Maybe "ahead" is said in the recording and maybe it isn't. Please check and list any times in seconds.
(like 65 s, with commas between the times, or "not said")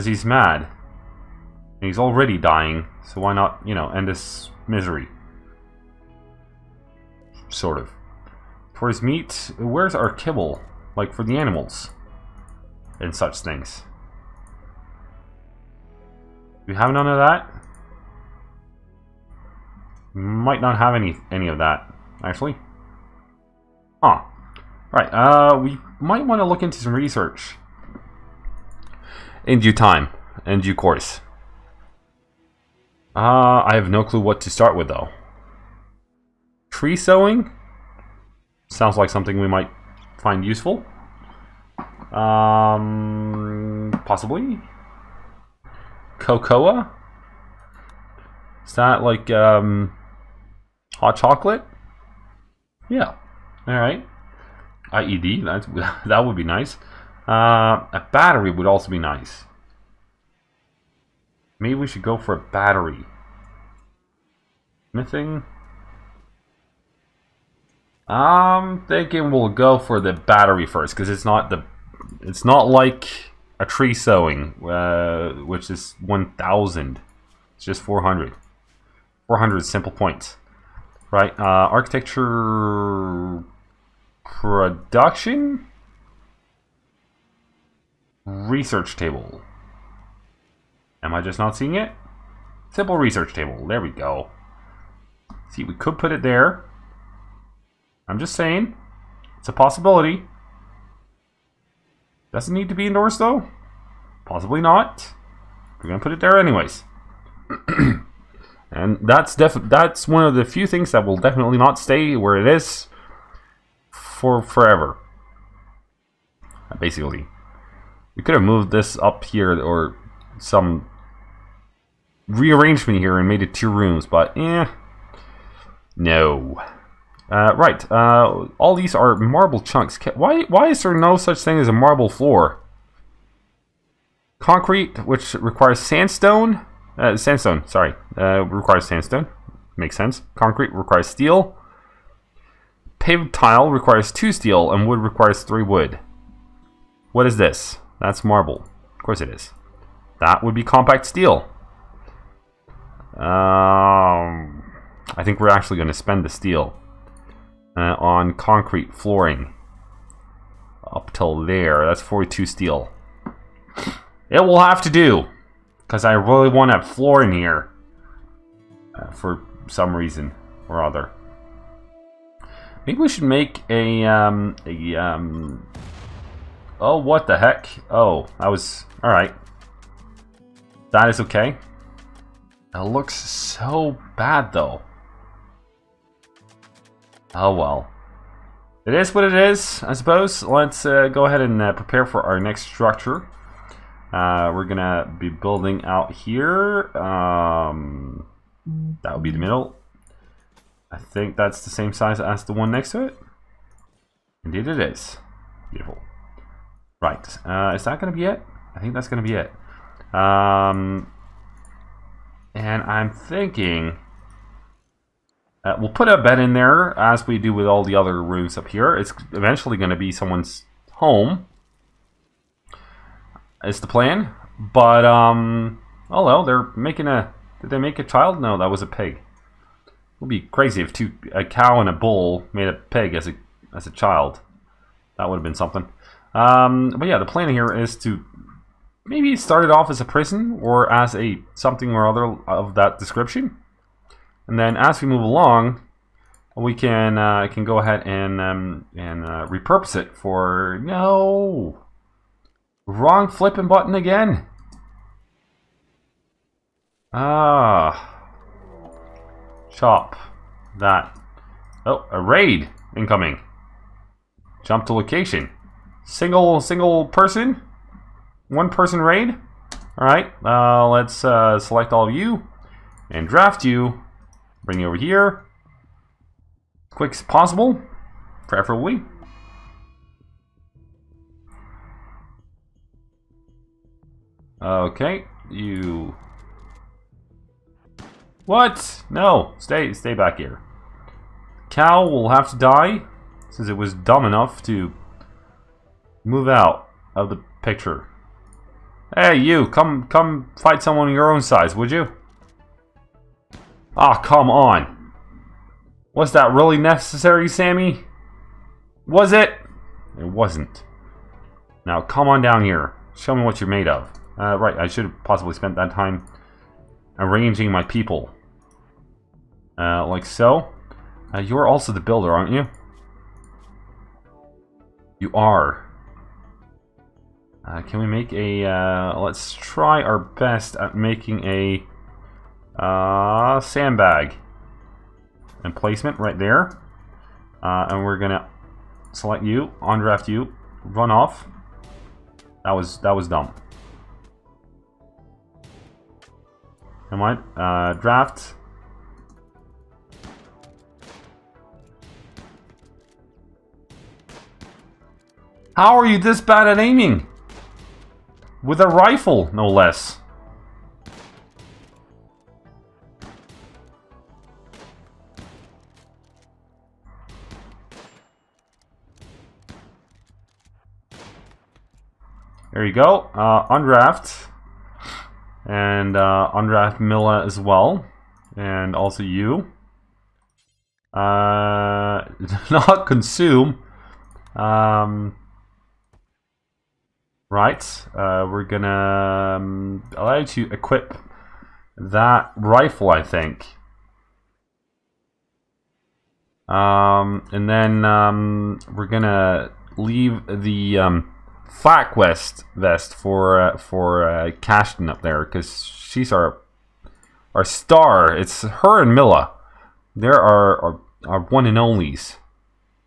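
191 s, 247 s.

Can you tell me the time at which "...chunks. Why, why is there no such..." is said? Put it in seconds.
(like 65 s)
129 s.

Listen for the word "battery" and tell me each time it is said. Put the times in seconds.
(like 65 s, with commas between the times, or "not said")
58 s, 62 s, 70 s.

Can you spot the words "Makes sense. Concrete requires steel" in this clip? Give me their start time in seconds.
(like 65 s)
139 s.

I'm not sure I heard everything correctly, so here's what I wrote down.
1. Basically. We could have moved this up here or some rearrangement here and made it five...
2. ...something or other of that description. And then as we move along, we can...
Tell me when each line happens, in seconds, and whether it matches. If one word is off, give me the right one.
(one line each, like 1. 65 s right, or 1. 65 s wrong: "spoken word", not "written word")
1. 116 s wrong: "two", not "five"
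2. 241 s right.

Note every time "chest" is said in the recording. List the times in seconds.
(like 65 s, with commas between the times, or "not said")
not said.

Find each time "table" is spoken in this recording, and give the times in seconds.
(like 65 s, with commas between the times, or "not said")
88 s, 93 s.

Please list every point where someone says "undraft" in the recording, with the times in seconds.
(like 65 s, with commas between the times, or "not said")
339 s, 373 s.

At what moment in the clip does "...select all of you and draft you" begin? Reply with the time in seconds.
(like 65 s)
271 s.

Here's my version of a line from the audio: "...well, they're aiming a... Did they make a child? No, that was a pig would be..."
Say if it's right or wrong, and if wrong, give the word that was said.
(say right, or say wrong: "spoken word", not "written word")
wrong: "making", not "aiming".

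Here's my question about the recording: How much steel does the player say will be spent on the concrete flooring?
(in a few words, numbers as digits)
42.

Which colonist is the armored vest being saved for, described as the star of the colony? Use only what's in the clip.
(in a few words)
Cashton.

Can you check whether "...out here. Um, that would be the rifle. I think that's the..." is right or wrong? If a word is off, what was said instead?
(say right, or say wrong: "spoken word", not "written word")
wrong: "middle", not "rifle".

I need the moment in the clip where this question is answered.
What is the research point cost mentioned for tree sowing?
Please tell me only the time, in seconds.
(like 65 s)
74 s.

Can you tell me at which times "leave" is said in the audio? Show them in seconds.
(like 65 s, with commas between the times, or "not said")
399 s.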